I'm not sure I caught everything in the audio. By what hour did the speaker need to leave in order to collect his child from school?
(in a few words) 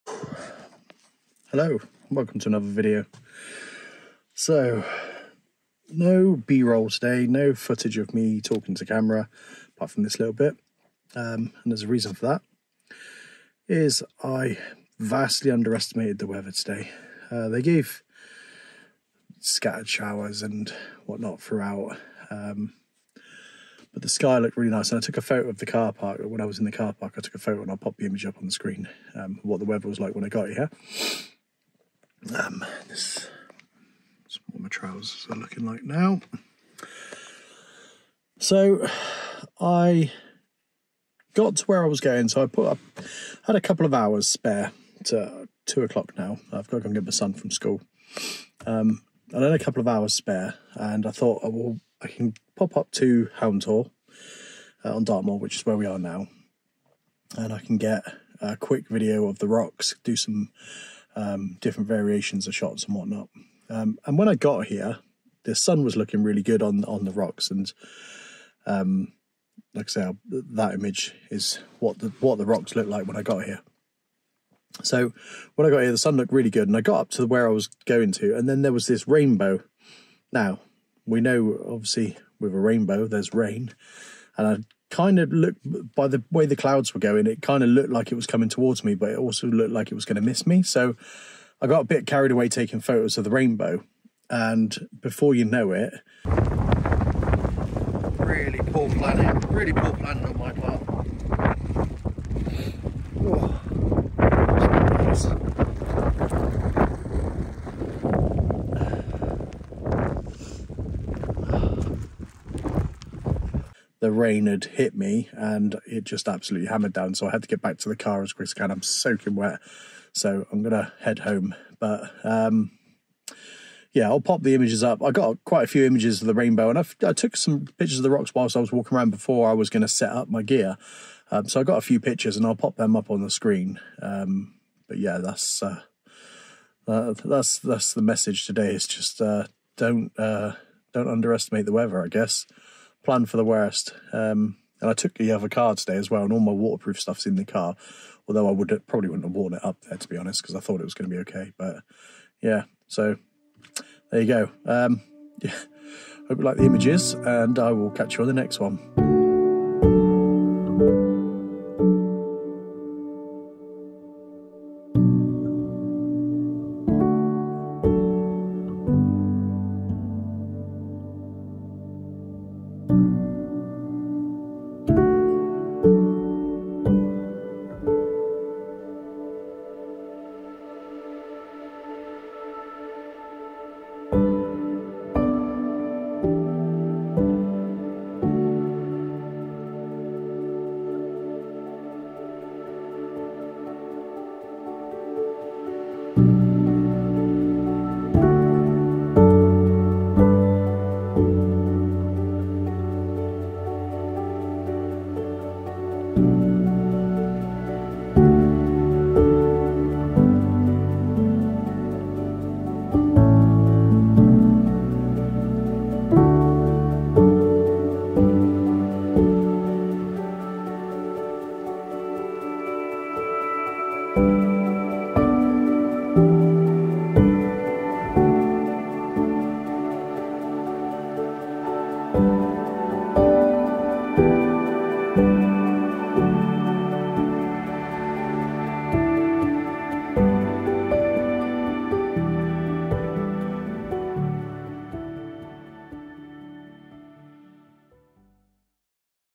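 2 o'clock.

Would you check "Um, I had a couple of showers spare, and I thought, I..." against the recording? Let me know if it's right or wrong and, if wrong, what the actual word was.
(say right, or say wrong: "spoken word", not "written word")
wrong: "hours", not "showers".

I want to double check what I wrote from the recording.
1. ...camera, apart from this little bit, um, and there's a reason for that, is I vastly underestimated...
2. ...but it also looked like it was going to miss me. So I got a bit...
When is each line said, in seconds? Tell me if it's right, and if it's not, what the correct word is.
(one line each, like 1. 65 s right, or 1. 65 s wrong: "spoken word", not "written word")
1. 8 s right
2. 88 s right.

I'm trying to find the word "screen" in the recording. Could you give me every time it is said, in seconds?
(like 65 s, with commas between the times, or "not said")
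28 s, 133 s.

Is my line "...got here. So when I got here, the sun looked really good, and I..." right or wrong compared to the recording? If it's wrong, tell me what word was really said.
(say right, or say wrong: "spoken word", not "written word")
right.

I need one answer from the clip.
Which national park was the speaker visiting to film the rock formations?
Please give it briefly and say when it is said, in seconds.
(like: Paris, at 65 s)
Dartmoor, at 55 s.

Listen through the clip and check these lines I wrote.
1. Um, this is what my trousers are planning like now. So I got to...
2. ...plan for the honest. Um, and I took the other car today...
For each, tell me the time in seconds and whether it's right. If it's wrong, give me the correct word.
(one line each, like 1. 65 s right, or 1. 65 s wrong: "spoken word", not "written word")
1. 32 s wrong: "looking", not "planning"
2. 143 s wrong: "worst", not "honest".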